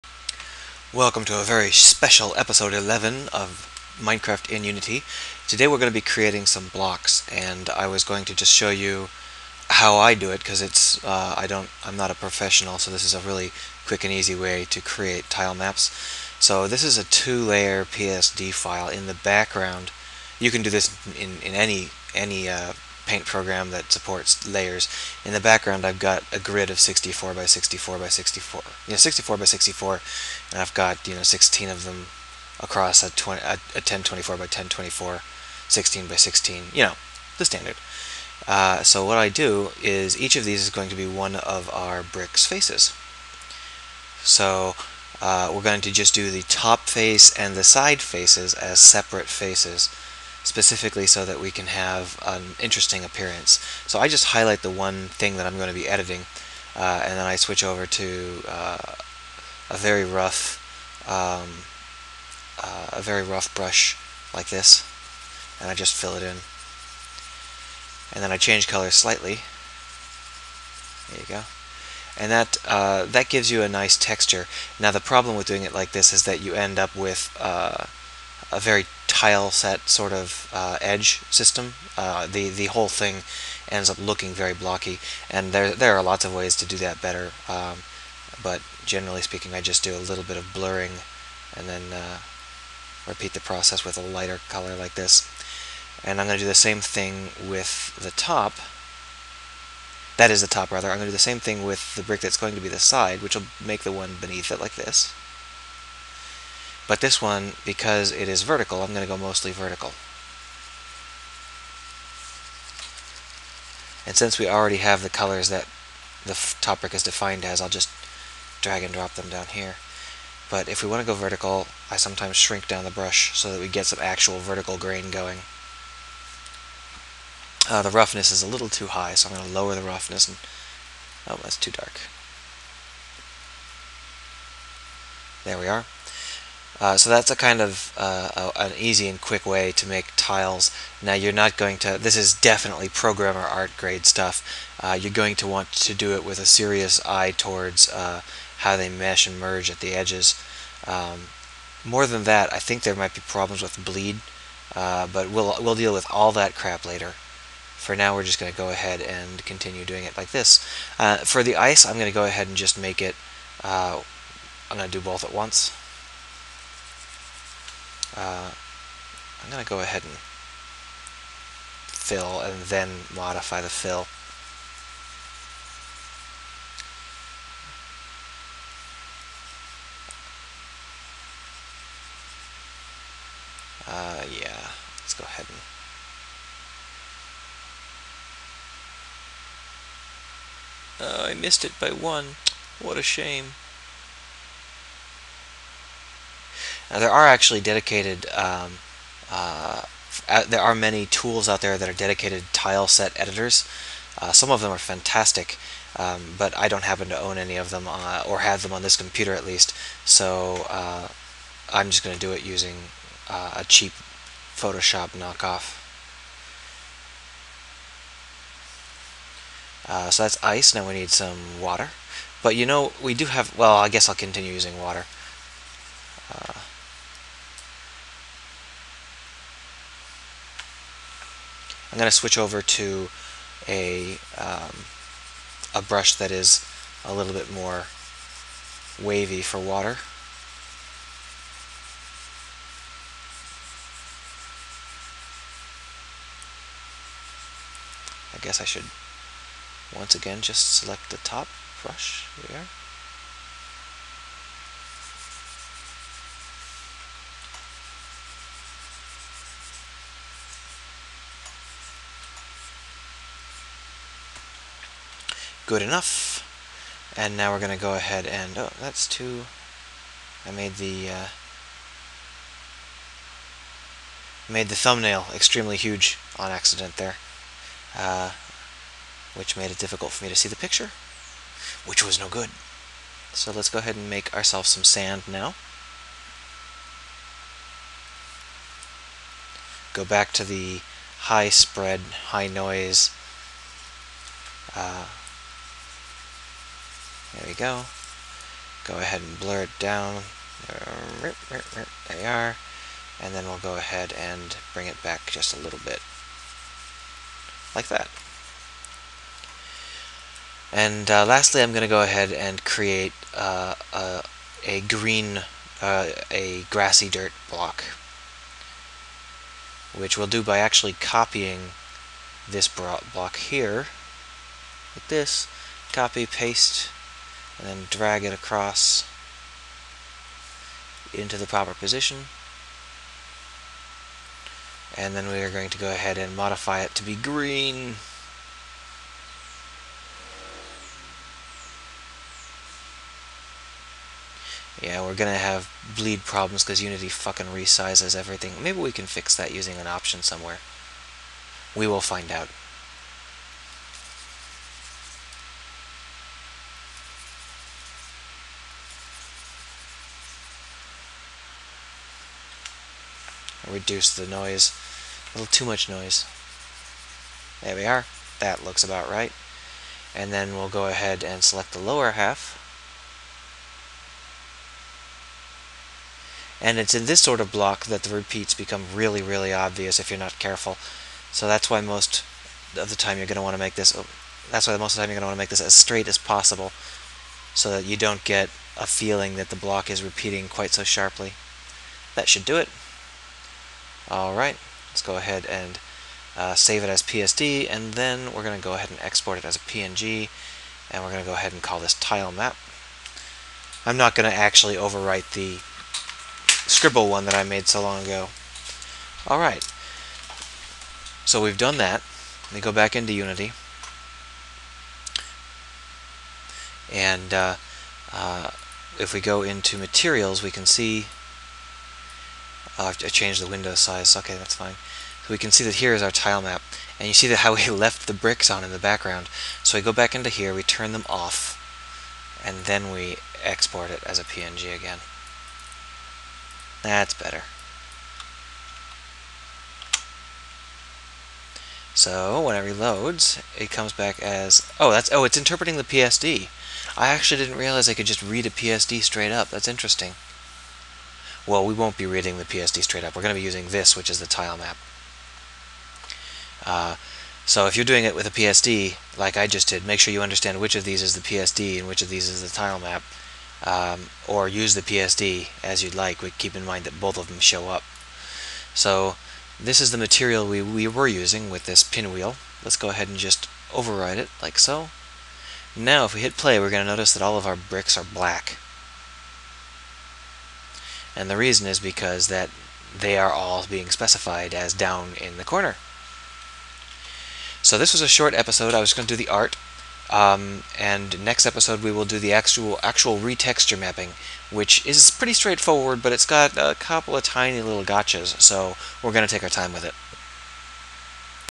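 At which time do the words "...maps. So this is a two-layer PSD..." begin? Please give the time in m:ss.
0:15.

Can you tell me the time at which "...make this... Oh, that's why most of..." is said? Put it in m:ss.
6:23.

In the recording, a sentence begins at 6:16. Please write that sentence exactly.
And it's in this sort of block that the repeats become really, really obvious if you're not careful.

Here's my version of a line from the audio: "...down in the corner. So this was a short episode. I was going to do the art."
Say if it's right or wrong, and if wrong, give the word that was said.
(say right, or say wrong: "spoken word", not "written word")
right.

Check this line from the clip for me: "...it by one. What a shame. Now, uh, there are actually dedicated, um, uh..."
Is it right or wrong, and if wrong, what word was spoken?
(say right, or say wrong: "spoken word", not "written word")
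right.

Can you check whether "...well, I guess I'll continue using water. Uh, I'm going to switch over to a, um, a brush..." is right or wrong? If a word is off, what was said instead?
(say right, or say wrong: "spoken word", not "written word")
right.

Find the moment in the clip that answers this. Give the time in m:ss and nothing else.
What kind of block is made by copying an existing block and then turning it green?
5:16.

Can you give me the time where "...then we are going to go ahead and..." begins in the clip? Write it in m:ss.
5:35.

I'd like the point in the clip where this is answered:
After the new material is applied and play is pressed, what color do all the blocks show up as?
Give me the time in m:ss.
7:58.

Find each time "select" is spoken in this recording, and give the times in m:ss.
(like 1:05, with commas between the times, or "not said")
4:10, 6:11.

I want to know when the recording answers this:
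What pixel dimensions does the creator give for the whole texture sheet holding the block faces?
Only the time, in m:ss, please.
0:33.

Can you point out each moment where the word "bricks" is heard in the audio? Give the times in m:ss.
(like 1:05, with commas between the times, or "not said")
0:42, 1:42, 7:08, 7:57.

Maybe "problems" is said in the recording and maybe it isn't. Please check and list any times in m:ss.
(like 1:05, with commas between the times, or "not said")
1:14, 2:33, 5:46.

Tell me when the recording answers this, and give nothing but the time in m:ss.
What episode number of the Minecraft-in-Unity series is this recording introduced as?
0:02.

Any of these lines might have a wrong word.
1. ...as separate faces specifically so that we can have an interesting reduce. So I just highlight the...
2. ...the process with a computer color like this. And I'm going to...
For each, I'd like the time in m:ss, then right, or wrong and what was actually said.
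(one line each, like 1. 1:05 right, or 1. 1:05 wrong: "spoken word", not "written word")
1. 0:48 wrong: "appearance", not "reduce"
2. 1:33 wrong: "lighter", not "computer".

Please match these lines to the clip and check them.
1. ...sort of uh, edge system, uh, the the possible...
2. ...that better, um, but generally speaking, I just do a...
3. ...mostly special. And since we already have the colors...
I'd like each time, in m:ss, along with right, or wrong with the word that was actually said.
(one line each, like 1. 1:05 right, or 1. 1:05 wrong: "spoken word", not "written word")
1. 1:19 wrong: "whole", not "possible"
2. 1:26 right
3. 1:49 wrong: "vertical", not "special".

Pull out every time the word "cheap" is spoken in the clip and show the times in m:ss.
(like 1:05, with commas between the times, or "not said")
3:33.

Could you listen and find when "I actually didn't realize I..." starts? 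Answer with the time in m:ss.
7:26.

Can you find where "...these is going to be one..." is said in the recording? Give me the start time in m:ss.
0:40.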